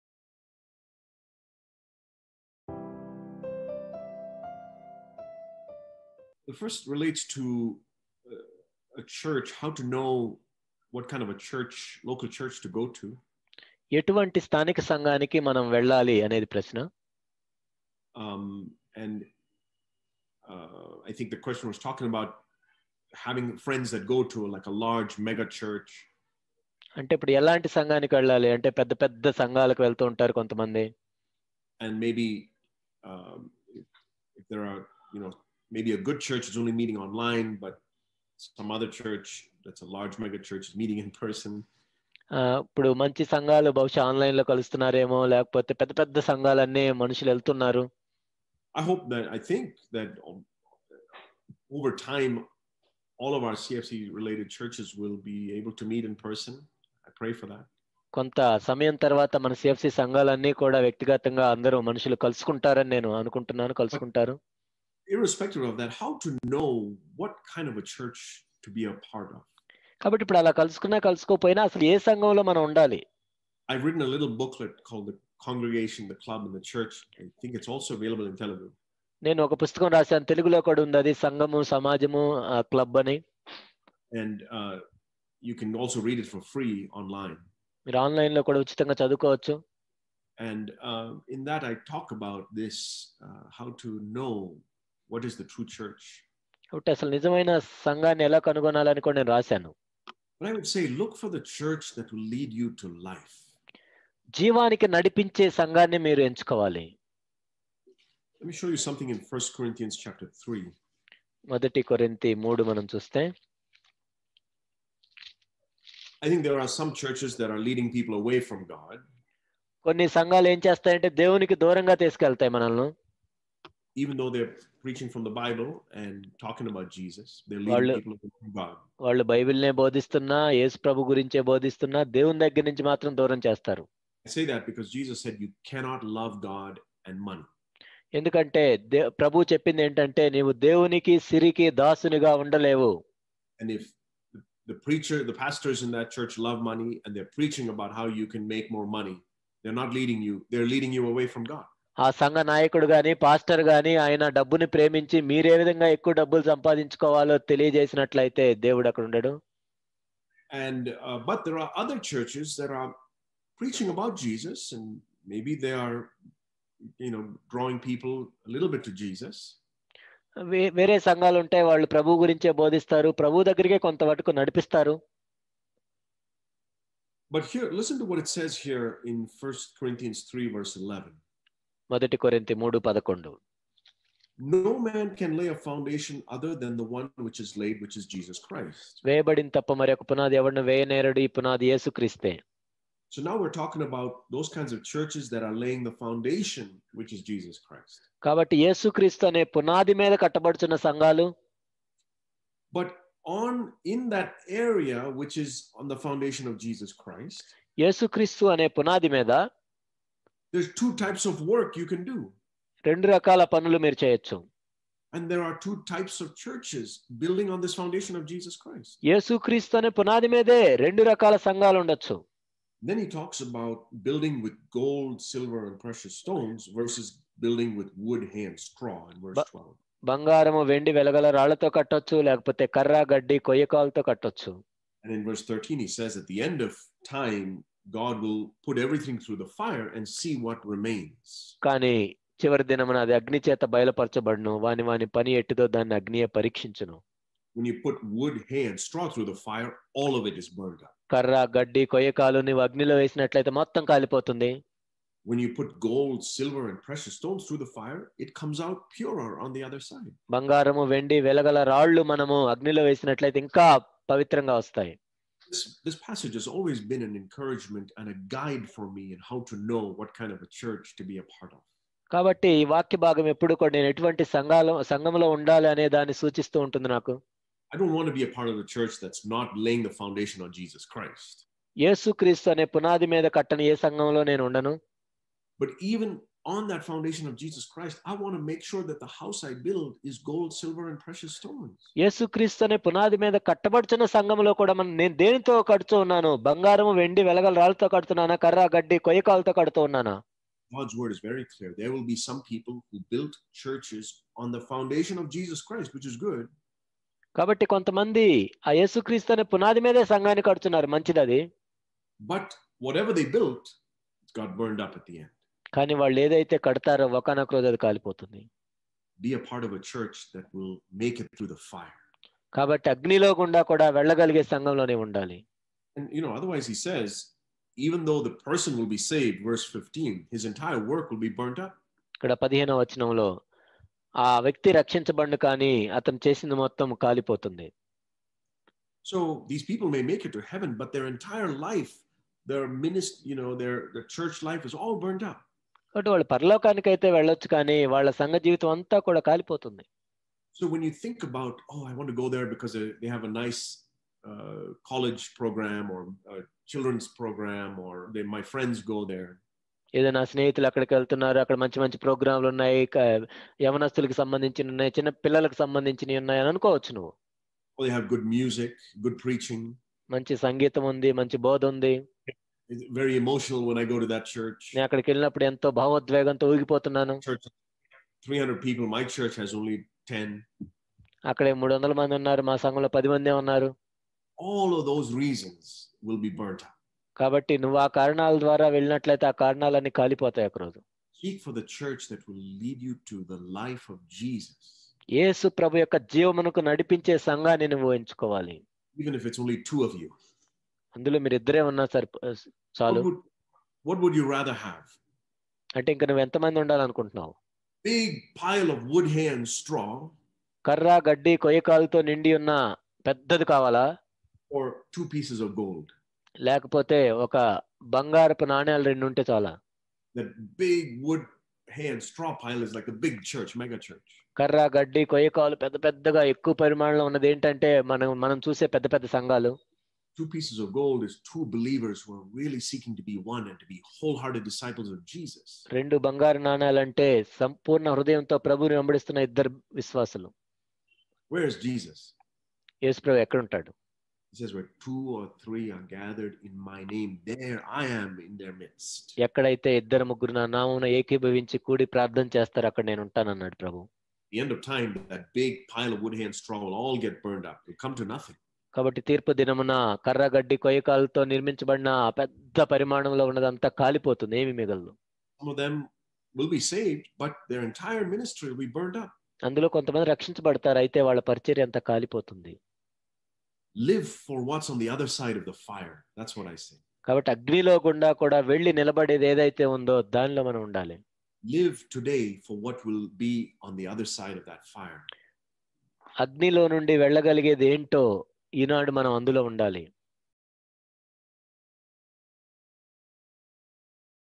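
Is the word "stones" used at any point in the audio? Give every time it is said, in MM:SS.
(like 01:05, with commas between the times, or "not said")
03:46, 04:17, 04:51.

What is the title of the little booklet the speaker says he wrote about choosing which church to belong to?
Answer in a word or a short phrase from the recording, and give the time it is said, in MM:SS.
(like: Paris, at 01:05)
The Congregation, the Club, and the Church, at 01:15.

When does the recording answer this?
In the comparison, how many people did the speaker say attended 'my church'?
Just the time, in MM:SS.
06:20.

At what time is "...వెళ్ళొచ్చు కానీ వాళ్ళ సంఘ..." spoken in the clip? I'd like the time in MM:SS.
05:47.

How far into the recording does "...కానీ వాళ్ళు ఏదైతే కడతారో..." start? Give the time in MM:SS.
05:15.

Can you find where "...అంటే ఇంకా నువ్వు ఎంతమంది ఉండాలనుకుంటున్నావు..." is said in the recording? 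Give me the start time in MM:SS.
06:45.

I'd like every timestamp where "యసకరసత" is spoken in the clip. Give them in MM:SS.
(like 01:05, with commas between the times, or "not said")
04:41, 05:08.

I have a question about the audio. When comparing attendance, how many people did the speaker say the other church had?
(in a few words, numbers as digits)
300.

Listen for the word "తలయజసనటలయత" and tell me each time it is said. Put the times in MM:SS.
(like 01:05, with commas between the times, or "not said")
02:37.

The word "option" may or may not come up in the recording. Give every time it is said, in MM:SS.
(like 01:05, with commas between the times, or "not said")
not said.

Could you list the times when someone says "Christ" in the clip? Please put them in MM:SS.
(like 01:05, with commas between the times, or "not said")
03:08, 03:17, 03:27, 03:38, 04:40, 04:47, 05:05.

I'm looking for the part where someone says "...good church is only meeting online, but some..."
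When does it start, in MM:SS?
00:35.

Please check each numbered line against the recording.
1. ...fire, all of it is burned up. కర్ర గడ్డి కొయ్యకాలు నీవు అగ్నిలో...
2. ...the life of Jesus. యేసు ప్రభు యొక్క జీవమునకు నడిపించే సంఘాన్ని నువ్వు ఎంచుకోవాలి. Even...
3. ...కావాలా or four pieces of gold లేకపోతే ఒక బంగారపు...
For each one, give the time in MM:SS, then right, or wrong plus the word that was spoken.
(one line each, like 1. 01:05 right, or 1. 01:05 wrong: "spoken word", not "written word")
1. 04:09 right
2. 06:33 right
3. 06:53 wrong: "two", not "four".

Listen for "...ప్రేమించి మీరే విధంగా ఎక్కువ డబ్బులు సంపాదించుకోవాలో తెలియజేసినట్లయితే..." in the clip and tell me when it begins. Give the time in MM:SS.
02:34.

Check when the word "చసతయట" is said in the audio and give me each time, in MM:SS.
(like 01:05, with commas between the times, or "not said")
02:00.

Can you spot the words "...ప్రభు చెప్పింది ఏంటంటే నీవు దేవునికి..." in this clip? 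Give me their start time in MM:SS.
02:19.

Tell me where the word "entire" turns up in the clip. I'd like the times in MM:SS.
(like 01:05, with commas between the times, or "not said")
05:30, 05:41.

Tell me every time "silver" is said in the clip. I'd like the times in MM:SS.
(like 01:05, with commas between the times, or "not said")
03:45, 04:16, 04:50.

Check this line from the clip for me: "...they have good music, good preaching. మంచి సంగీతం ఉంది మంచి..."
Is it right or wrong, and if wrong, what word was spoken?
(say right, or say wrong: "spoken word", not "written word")
right.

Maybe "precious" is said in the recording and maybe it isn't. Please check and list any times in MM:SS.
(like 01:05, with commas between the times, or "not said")
03:45, 04:16, 04:51.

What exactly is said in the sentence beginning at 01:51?
మొదటి కొరింతి 3 మనం చూస్తే I think there are some churches that are leading people away from God.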